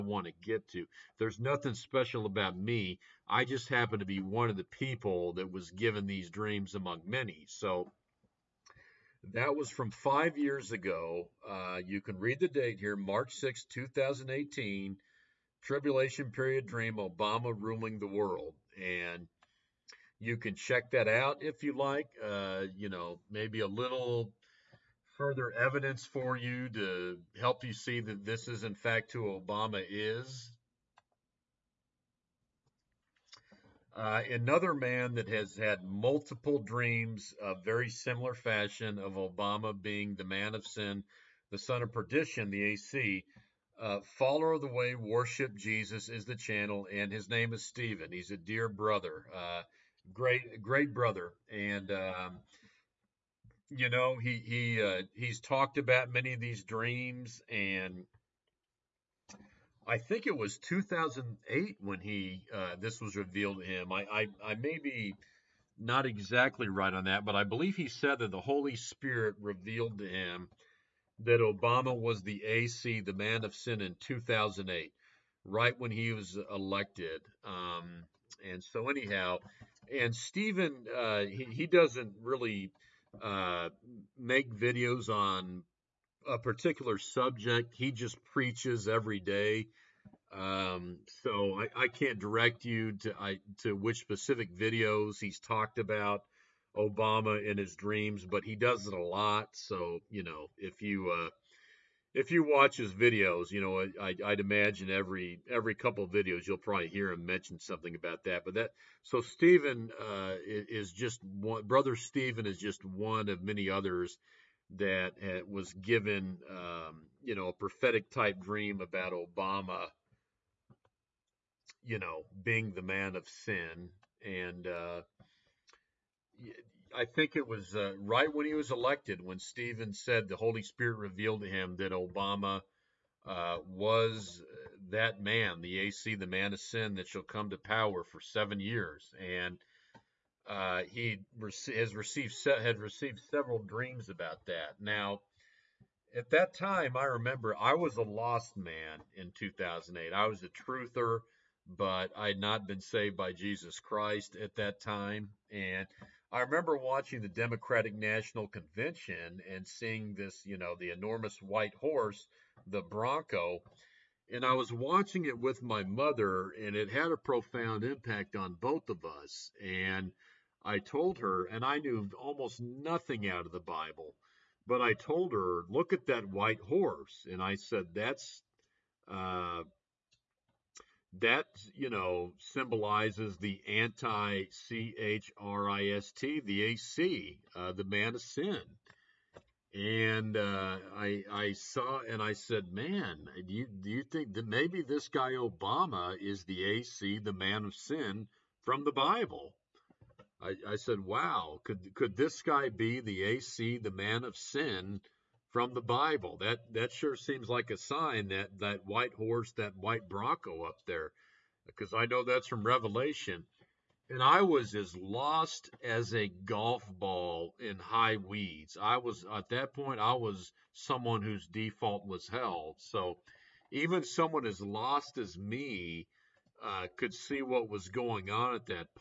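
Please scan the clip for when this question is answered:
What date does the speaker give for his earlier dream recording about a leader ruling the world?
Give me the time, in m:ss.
0:12.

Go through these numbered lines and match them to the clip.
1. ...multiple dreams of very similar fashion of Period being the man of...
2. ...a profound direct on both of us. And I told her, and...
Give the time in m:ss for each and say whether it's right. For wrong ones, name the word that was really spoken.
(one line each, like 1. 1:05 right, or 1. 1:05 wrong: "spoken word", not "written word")
1. 0:35 wrong: "Obama", not "Period"
2. 2:47 wrong: "impact", not "direct".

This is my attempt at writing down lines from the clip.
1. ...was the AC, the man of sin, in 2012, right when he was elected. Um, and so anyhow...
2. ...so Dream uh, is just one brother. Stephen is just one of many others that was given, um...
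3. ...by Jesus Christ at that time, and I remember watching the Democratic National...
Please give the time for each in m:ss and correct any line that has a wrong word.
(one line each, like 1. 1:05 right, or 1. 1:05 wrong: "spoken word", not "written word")
1. 1:11 wrong: "2008", not "2012"
2. 1:49 wrong: "Stephen", not "Dream"
3. 2:33 right.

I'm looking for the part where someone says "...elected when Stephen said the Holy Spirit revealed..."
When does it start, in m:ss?
2:08.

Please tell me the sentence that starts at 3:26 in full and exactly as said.
That that sure seems like a sign that that white horse, that white bronco up there, because I know that's from Revelation.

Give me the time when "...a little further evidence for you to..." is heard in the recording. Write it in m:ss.
0:23.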